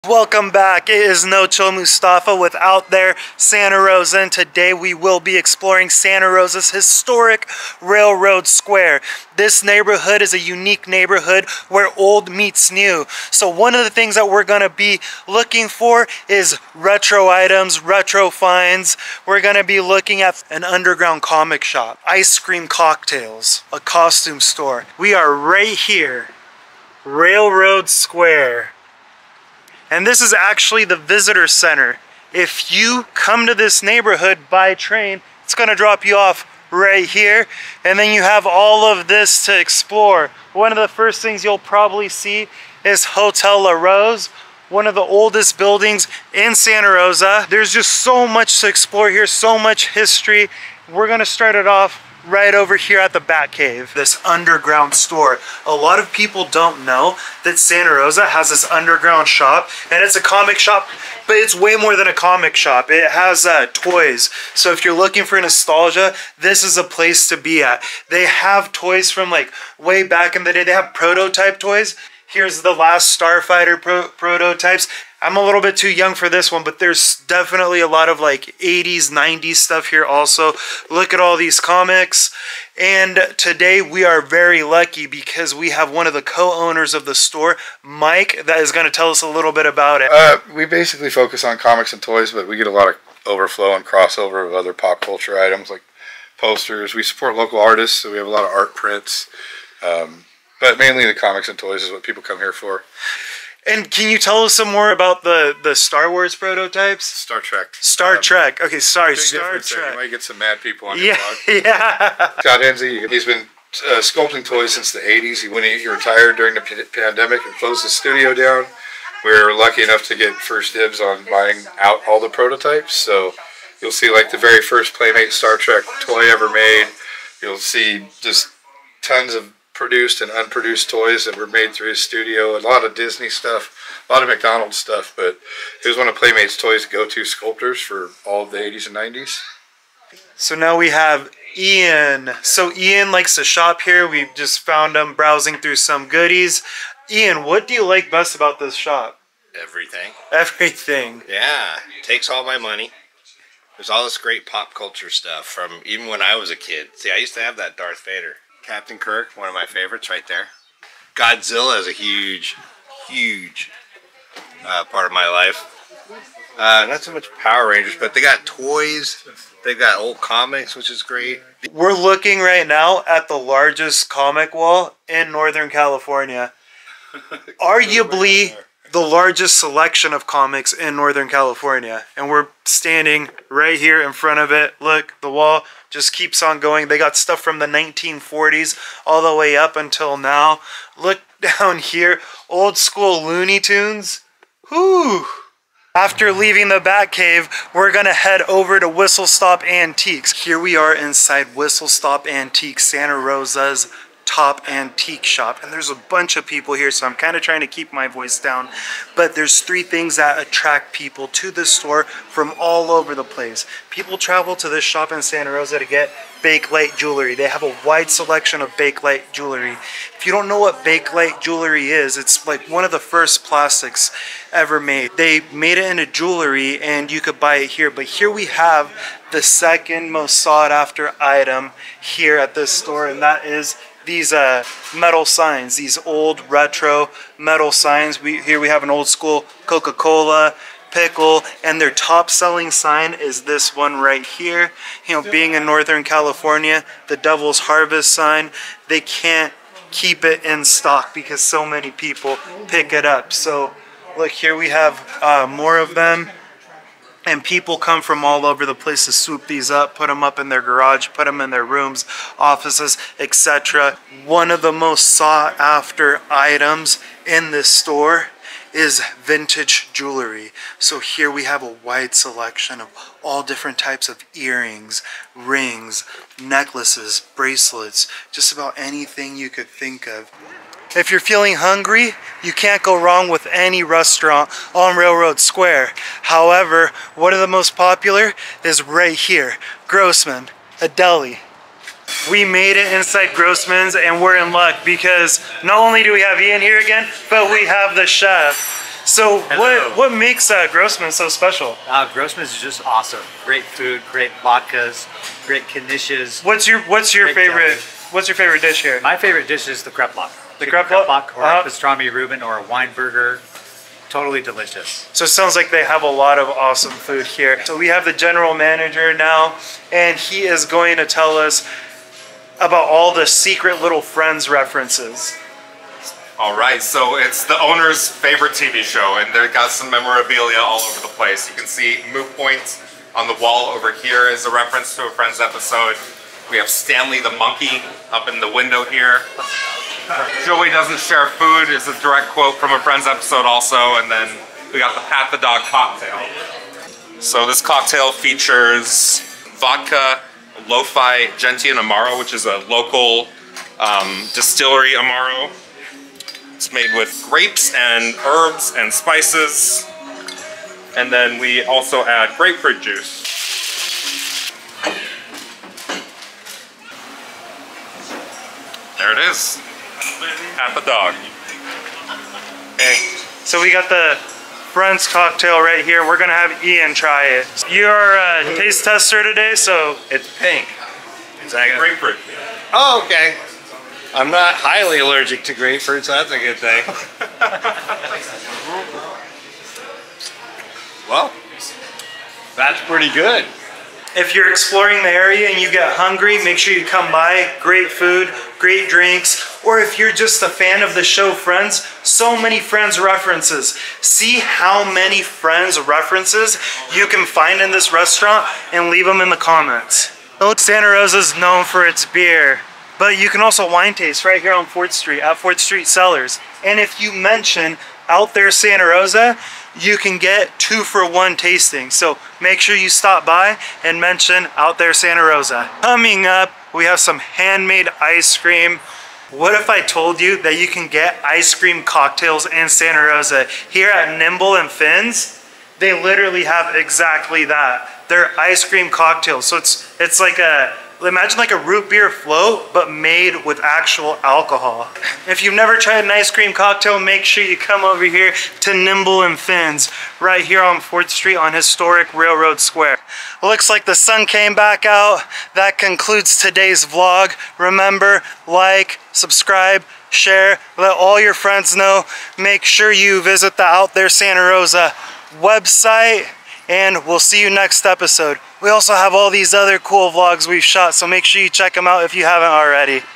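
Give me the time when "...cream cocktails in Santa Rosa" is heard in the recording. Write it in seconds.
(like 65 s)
431 s.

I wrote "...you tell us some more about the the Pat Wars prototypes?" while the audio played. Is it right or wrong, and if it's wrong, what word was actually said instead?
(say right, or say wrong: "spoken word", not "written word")
wrong: "Star", not "Pat".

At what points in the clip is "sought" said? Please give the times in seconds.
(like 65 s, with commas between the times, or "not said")
230 s, 265 s.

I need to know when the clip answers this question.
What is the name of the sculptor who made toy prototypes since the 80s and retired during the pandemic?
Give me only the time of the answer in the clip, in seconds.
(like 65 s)
112 s.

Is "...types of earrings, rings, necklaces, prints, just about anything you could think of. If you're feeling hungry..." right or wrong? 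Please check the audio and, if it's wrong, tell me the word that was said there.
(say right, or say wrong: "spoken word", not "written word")
wrong: "bracelets", not "prints".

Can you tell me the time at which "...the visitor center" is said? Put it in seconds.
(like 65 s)
30 s.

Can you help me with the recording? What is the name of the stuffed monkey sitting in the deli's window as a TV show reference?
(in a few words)
Stanley.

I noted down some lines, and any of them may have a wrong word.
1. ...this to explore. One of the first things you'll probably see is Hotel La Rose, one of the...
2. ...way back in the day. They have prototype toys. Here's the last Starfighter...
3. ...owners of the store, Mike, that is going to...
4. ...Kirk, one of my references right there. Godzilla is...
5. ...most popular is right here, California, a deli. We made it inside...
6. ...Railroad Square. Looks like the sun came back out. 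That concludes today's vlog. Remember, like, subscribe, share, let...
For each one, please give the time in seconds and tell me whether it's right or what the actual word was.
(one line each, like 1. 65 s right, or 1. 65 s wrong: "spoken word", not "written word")
1. 39 s right
2. 69 s right
3. 86 s right
4. 158 s wrong: "favorites", not "references"
5. 287 s wrong: "Grossman", not "California"
6. 452 s right.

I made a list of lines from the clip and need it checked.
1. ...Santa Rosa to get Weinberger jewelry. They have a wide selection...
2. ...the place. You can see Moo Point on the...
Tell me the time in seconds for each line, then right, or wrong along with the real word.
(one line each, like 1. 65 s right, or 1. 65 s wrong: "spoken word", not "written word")
1. 215 s wrong: "Bakelite", not "Weinberger"
2. 331 s right.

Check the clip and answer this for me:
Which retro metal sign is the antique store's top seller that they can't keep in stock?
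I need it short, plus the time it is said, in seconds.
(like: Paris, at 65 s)
Devil's Harvest, at 247 s.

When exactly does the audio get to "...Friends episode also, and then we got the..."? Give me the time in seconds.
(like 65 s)
342 s.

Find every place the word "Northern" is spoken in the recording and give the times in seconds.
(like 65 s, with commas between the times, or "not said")
175 s, 180 s, 245 s.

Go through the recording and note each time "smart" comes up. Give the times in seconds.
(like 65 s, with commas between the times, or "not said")
not said.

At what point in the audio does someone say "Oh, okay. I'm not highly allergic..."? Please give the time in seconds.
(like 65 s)
382 s.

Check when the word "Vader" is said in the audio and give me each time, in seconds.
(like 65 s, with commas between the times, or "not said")
158 s.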